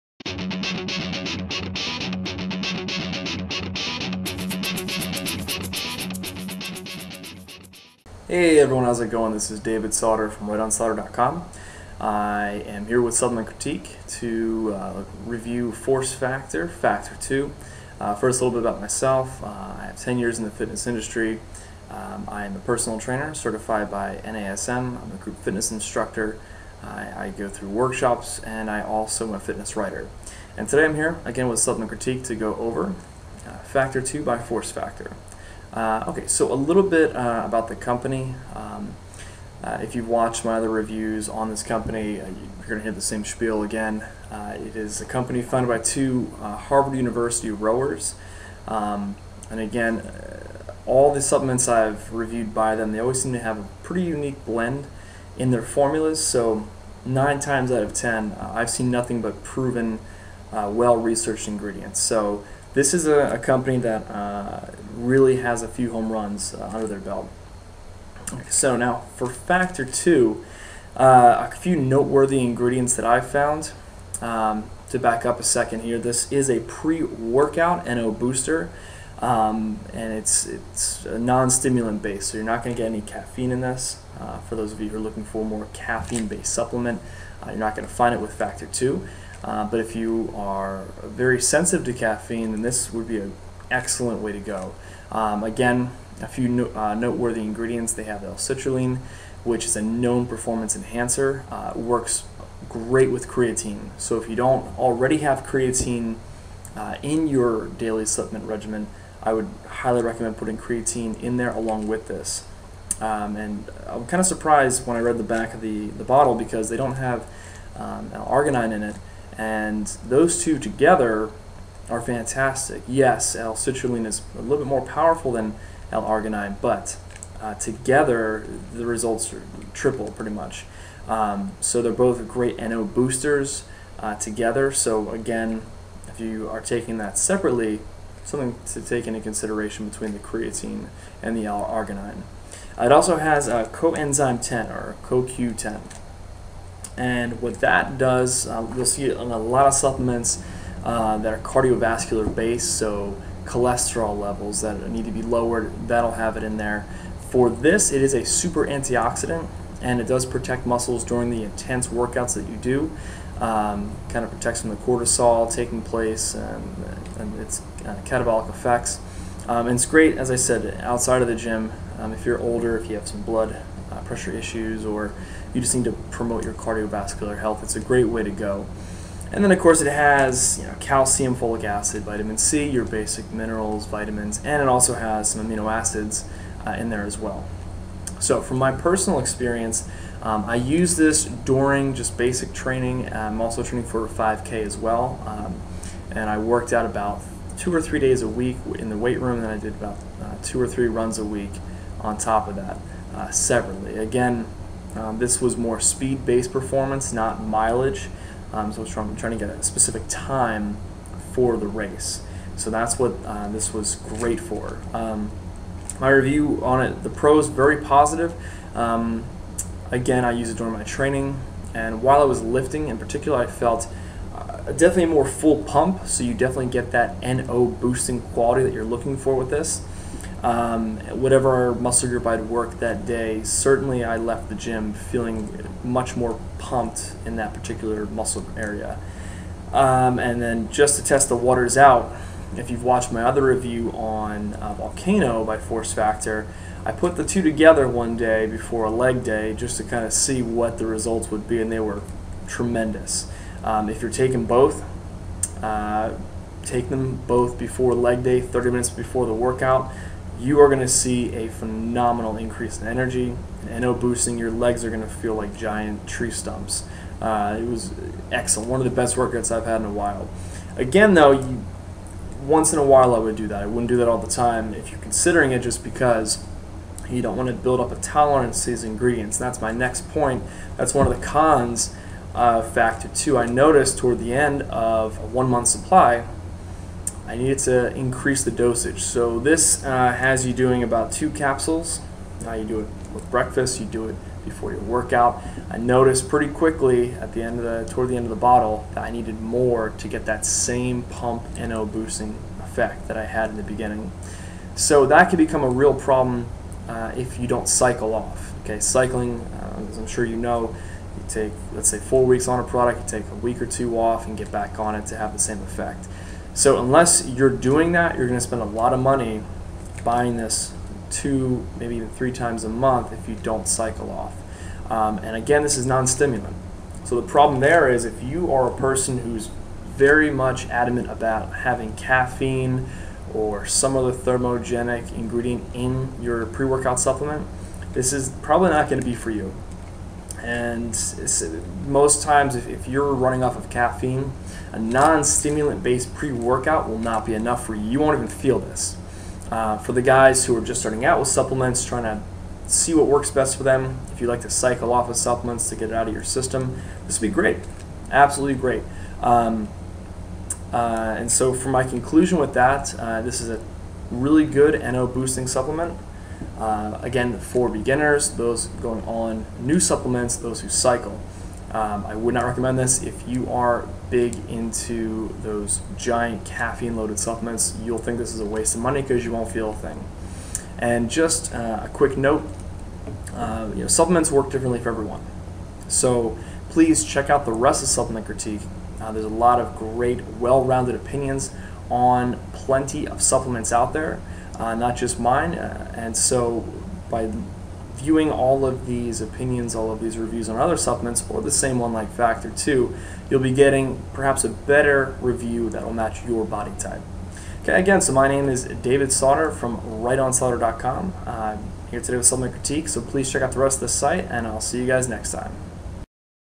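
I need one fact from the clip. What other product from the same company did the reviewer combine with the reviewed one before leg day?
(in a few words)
Volcano.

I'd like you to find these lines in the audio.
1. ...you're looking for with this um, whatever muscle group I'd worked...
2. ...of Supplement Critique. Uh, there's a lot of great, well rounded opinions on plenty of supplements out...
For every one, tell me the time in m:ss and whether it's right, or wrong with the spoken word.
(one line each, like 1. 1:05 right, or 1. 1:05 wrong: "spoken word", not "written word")
1. 3:48 right
2. 6:27 right.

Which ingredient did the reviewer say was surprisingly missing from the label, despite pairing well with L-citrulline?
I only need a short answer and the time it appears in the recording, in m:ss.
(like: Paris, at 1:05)
arginine, at 1:58.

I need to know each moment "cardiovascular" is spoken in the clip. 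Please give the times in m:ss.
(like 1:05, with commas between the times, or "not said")
2:31, 2:56.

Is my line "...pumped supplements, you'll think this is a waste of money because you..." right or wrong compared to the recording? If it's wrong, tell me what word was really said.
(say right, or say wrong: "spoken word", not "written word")
wrong: "loaded", not "pumped".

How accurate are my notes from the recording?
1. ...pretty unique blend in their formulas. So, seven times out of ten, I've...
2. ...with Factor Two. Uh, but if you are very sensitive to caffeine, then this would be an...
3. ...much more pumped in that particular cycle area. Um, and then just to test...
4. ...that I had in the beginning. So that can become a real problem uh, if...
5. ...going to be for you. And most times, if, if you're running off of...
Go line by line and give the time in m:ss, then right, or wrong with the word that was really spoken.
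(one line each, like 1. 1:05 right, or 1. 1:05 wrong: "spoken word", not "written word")
1. 0:53 wrong: "nine", not "seven"
2. 1:28 right
3. 3:55 wrong: "muscle", not "cycle"
4. 5:03 right
5. 5:38 right.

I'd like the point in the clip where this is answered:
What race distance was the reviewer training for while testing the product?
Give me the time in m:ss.
3:14.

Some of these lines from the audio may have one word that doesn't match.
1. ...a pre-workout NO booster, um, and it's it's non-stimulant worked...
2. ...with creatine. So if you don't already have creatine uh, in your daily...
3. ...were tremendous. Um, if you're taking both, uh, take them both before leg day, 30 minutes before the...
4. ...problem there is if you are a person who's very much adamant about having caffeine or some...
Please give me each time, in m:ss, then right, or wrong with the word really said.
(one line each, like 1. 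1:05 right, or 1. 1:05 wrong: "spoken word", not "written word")
1. 1:16 wrong: "based", not "worked"
2. 1:43 right
3. 4:11 right
4. 5:27 right.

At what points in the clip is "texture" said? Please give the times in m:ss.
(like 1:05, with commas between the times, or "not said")
not said.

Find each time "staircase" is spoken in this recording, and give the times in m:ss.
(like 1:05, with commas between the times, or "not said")
not said.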